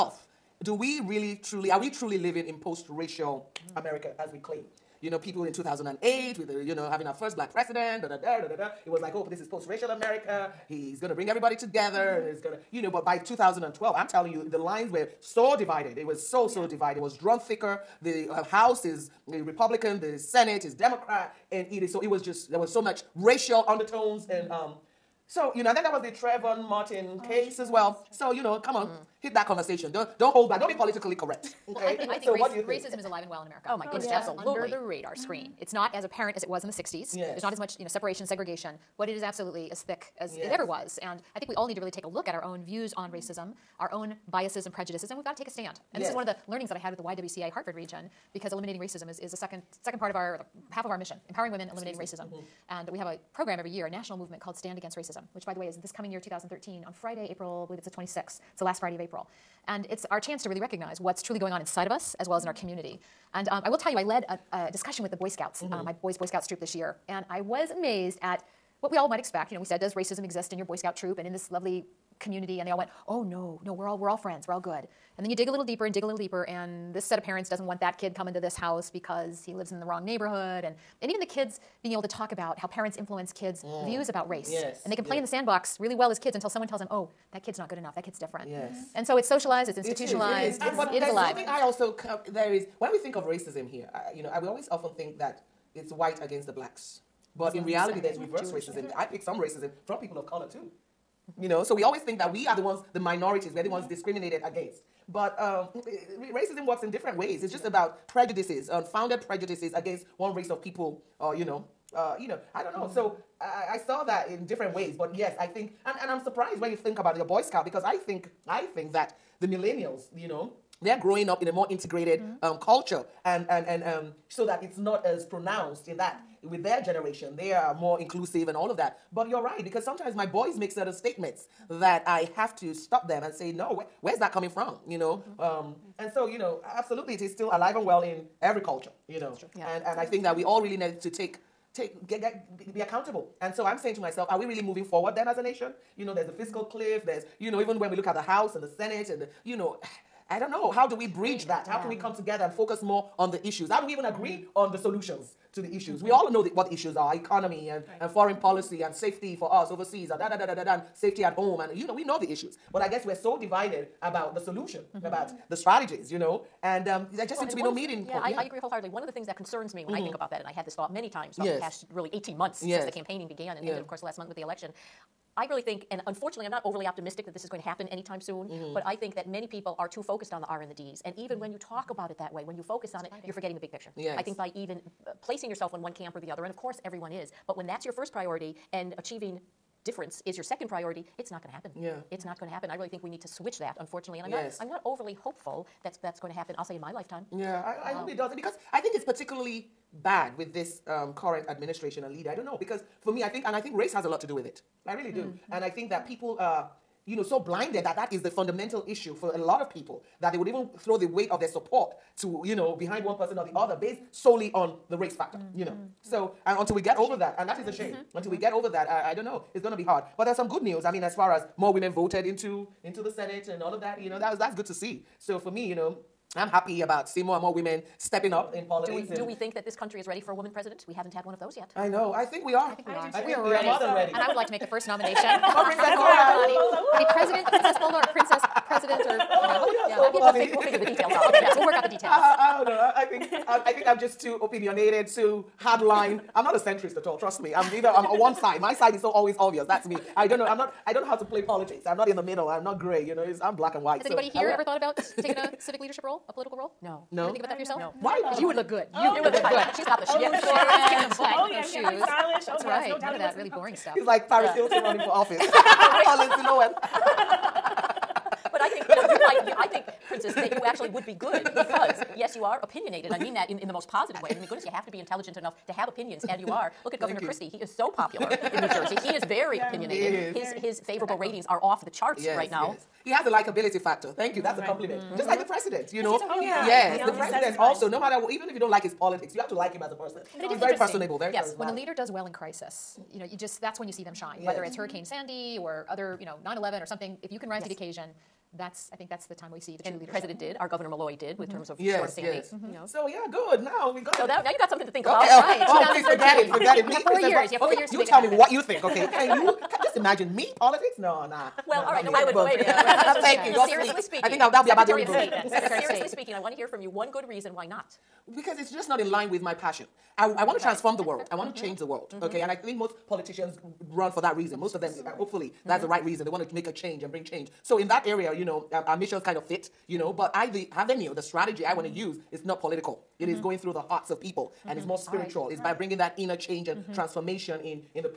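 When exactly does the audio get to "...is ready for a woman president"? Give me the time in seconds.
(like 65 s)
229 s.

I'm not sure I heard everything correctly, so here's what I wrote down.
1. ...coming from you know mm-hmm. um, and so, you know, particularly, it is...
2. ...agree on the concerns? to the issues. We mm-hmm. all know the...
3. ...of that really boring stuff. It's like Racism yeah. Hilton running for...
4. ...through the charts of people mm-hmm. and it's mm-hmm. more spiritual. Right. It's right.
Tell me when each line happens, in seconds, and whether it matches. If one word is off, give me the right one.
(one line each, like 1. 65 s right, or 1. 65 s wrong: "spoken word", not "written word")
1. 134 s wrong: "absolutely", not "particularly"
2. 154 s wrong: "solutions", not "concerns"
3. 263 s wrong: "Paris", not "Racism"
4. 333 s wrong: "hearts", not "charts".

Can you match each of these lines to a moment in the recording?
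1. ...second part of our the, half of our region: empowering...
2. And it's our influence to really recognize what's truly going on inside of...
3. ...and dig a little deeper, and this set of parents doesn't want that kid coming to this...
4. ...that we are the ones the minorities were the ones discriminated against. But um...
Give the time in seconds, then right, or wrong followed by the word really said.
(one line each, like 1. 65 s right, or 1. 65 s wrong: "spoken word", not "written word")
1. 49 s wrong: "mission", not "region"
2. 59 s wrong: "chance", not "influence"
3. 75 s right
4. 102 s right.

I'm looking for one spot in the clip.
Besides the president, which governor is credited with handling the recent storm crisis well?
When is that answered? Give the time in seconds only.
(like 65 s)
300 s.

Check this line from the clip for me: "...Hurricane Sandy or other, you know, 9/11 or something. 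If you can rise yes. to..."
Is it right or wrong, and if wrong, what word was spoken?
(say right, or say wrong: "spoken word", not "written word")
right.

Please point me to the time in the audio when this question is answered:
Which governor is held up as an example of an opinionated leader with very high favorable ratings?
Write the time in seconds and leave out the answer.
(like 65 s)
276 s.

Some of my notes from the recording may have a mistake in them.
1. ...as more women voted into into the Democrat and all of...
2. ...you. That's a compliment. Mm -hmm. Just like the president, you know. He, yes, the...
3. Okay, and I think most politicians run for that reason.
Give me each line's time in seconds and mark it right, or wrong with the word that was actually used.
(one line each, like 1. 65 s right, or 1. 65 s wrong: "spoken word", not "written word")
1. 221 s wrong: "Senate", not "Democrat"
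2. 284 s right
3. 322 s right.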